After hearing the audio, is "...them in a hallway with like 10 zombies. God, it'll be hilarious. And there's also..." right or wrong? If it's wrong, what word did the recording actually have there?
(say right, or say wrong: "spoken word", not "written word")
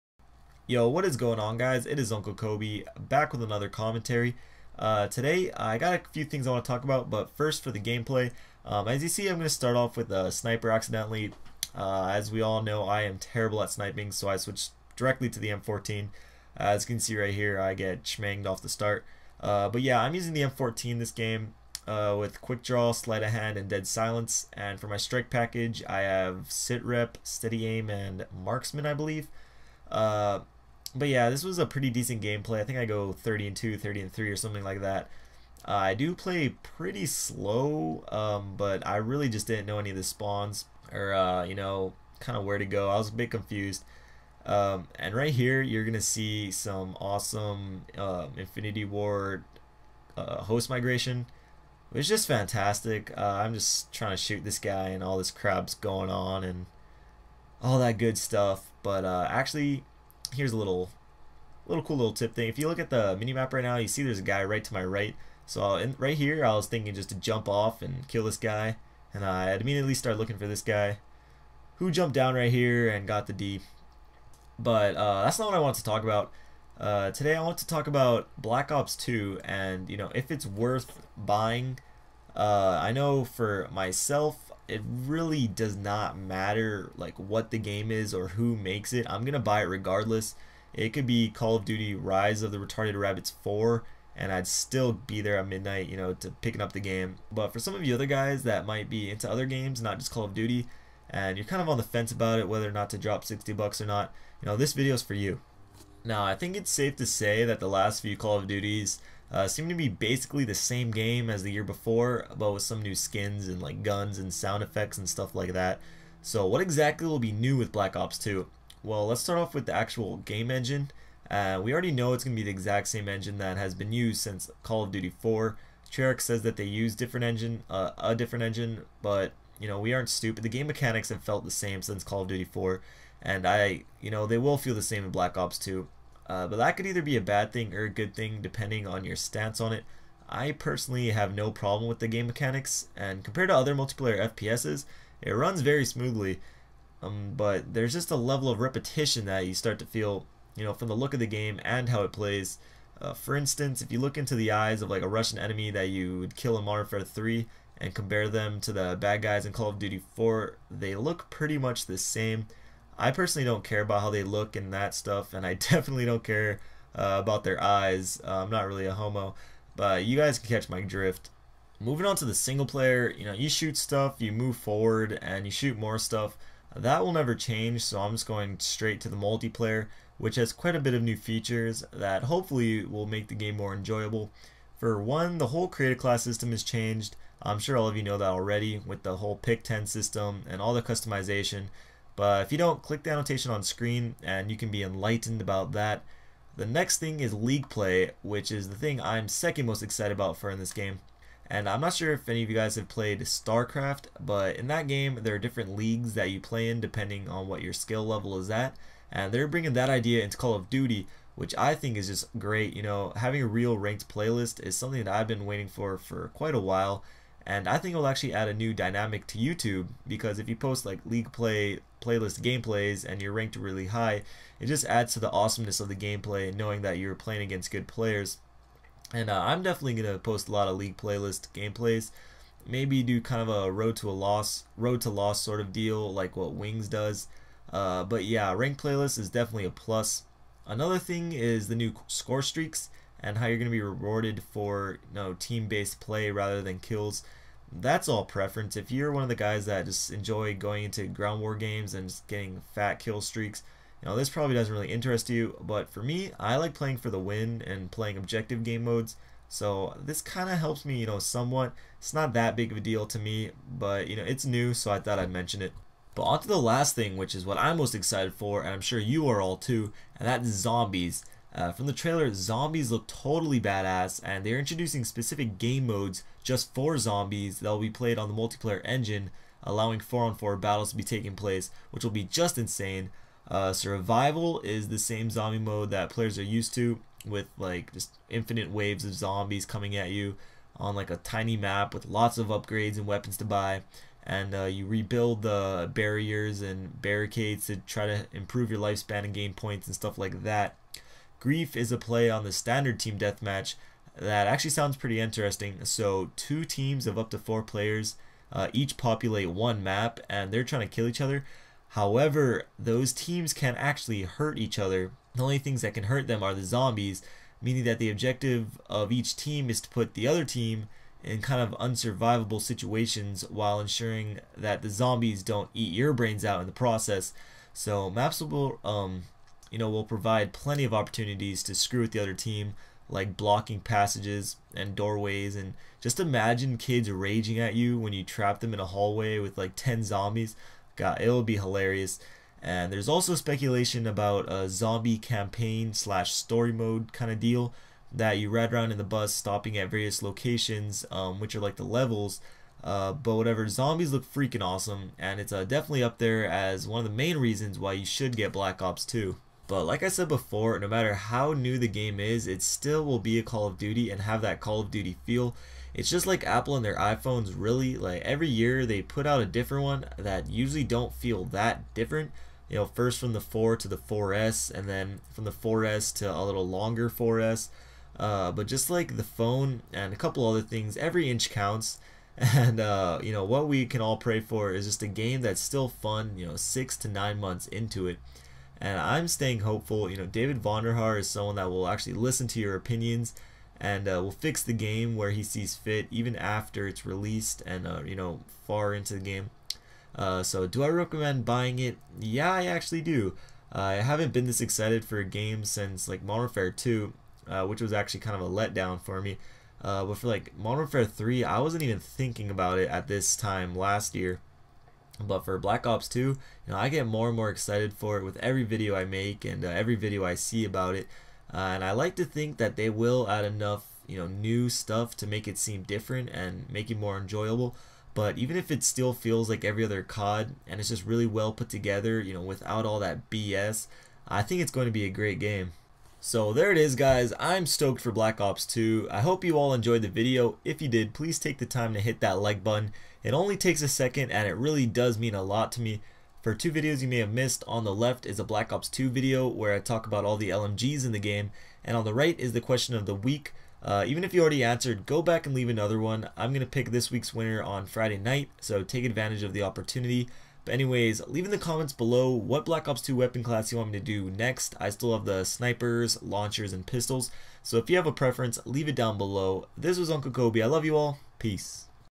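right.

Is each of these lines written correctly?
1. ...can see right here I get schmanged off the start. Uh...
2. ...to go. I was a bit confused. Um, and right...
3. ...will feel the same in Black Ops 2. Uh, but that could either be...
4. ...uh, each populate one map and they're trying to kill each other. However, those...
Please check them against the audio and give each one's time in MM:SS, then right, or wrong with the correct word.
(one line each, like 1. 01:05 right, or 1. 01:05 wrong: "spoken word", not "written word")
1. 00:16 right
2. 00:42 right
3. 02:14 right
4. 05:08 right.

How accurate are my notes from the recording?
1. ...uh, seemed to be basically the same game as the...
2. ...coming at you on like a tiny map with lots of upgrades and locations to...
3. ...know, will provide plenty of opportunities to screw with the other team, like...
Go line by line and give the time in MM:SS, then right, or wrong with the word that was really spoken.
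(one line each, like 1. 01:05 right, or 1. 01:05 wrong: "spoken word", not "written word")
1. 01:49 right
2. 04:49 wrong: "weapons", not "locations"
3. 05:29 right.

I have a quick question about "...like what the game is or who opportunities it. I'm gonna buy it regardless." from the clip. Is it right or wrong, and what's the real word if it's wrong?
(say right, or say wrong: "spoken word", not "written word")
wrong: "makes", not "opportunities".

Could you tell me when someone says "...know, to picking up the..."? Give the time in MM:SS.
01:35.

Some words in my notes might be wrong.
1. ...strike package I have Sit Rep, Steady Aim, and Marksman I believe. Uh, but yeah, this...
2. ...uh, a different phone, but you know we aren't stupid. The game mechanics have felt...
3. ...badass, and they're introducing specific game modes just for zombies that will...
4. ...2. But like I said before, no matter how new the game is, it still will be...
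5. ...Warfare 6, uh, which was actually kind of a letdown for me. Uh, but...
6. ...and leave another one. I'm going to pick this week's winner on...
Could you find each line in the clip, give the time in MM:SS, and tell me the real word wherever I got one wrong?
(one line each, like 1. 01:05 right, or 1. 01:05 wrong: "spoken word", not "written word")
1. 00:24 right
2. 02:07 wrong: "engine", not "phone"
3. 04:33 right
4. 05:59 right
5. 06:46 wrong: "2", not "6"
6. 07:35 right.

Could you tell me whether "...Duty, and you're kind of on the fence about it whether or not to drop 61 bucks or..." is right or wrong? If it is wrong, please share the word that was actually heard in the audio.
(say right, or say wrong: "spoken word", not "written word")
wrong: "60", not "61".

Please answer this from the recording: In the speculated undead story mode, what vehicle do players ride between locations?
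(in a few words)
the bus.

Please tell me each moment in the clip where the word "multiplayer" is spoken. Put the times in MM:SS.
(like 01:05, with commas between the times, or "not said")
02:23, 02:59, 04:38.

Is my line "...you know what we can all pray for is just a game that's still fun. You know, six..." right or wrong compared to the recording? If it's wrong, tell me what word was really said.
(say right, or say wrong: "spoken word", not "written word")
right.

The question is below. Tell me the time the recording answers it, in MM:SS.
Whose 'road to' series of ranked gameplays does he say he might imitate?
03:56.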